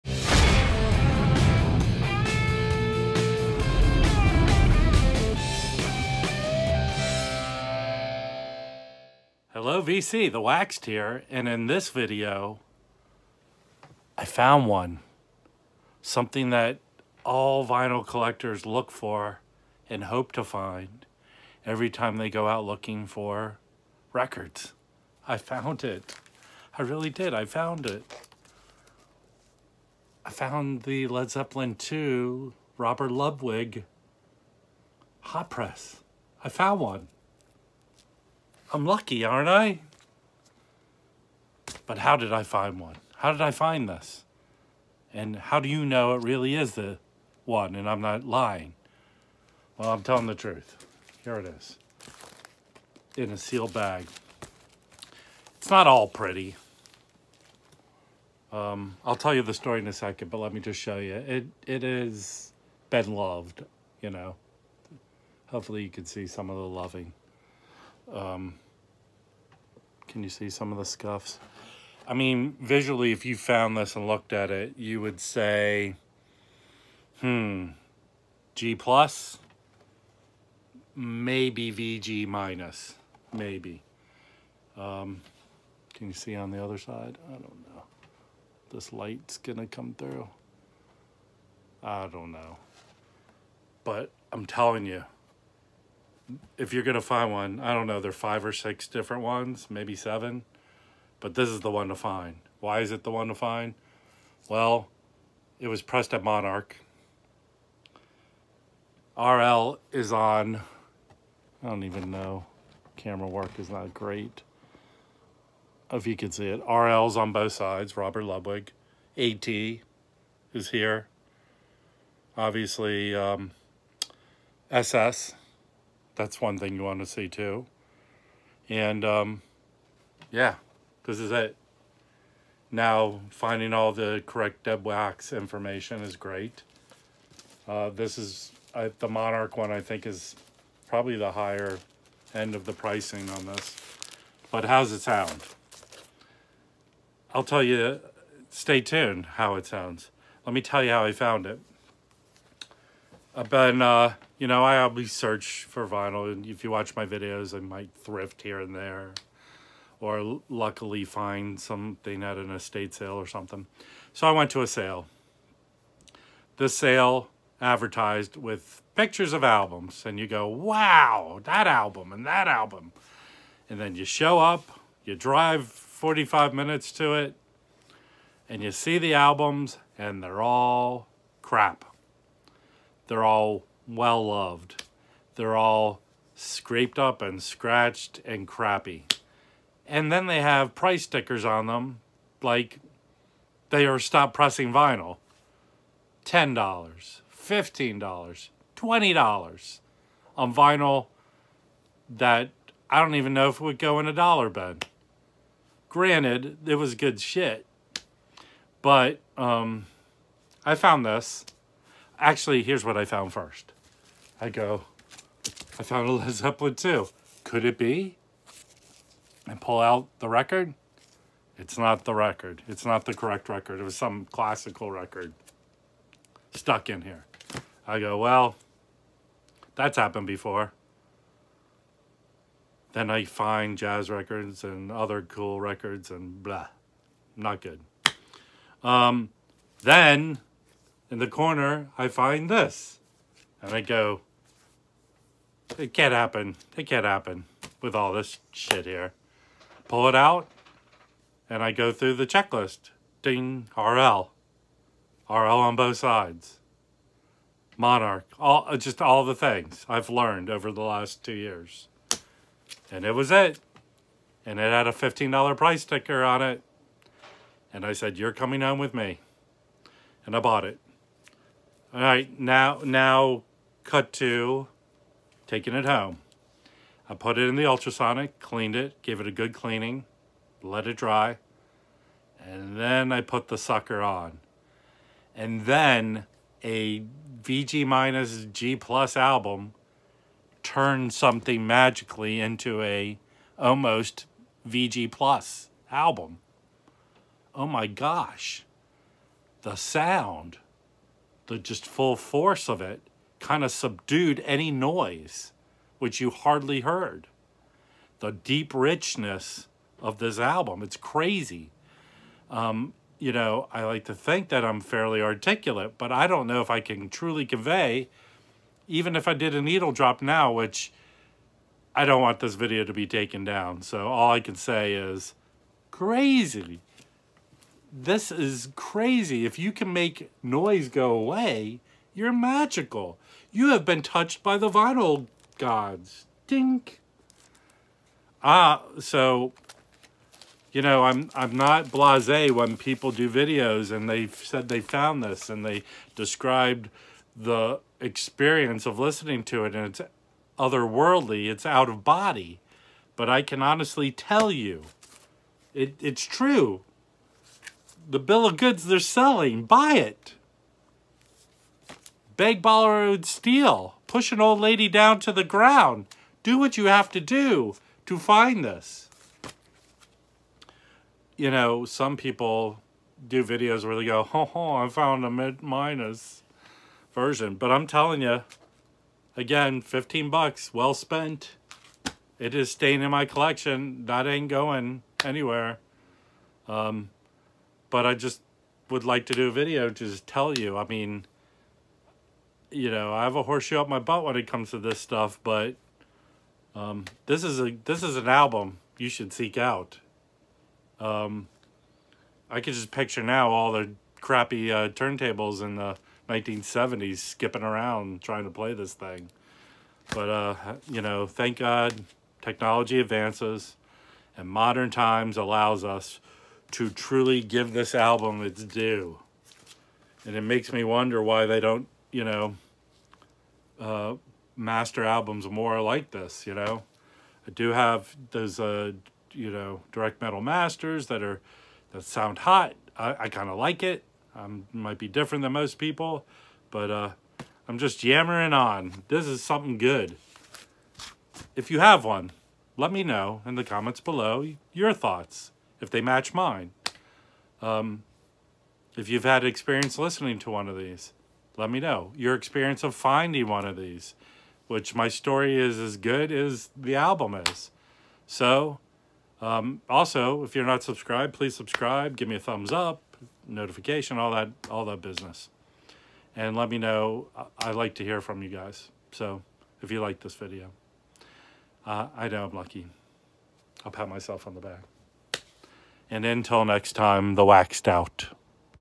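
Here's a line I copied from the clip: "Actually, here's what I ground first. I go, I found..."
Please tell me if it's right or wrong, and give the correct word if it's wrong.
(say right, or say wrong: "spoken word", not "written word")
wrong: "found", not "ground".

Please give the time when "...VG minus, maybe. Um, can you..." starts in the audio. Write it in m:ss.
1:21.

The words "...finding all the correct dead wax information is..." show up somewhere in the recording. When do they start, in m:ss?
2:13.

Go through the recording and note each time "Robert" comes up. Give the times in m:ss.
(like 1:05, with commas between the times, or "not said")
0:32, 1:57.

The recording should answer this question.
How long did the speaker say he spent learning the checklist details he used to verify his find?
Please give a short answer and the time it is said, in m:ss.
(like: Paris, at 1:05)
two years, at 4:21.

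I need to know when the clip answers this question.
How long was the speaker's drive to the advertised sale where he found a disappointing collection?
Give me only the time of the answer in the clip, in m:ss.
2:55.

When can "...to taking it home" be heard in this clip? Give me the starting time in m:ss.
4:34.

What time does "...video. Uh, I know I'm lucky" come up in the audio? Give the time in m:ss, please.
7:50.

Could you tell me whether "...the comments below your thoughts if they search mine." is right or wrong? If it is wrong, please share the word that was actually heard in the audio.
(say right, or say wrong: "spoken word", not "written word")
wrong: "match", not "search".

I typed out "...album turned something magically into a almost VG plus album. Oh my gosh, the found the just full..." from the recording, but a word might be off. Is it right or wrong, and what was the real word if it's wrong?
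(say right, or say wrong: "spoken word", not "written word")
wrong: "sound", not "found".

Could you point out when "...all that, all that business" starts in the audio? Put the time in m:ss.
7:44.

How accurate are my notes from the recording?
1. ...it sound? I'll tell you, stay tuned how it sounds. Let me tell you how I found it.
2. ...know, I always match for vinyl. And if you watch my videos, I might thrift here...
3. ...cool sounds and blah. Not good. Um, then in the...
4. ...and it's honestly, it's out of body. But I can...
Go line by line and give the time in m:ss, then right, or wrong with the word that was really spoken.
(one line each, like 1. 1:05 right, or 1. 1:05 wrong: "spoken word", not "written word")
1. 2:24 right
2. 2:34 wrong: "search", not "match"
3. 3:55 wrong: "records", not "sounds"
4. 5:49 wrong: "otherworldly", not "honestly".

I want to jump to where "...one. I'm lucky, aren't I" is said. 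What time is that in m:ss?
0:36.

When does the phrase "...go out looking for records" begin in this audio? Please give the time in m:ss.
0:22.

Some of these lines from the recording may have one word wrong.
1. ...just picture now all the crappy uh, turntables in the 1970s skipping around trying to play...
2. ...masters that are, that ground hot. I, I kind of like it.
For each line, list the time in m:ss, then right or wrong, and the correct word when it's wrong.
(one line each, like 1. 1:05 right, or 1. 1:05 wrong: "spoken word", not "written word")
1. 6:42 right
2. 7:10 wrong: "sound", not "ground".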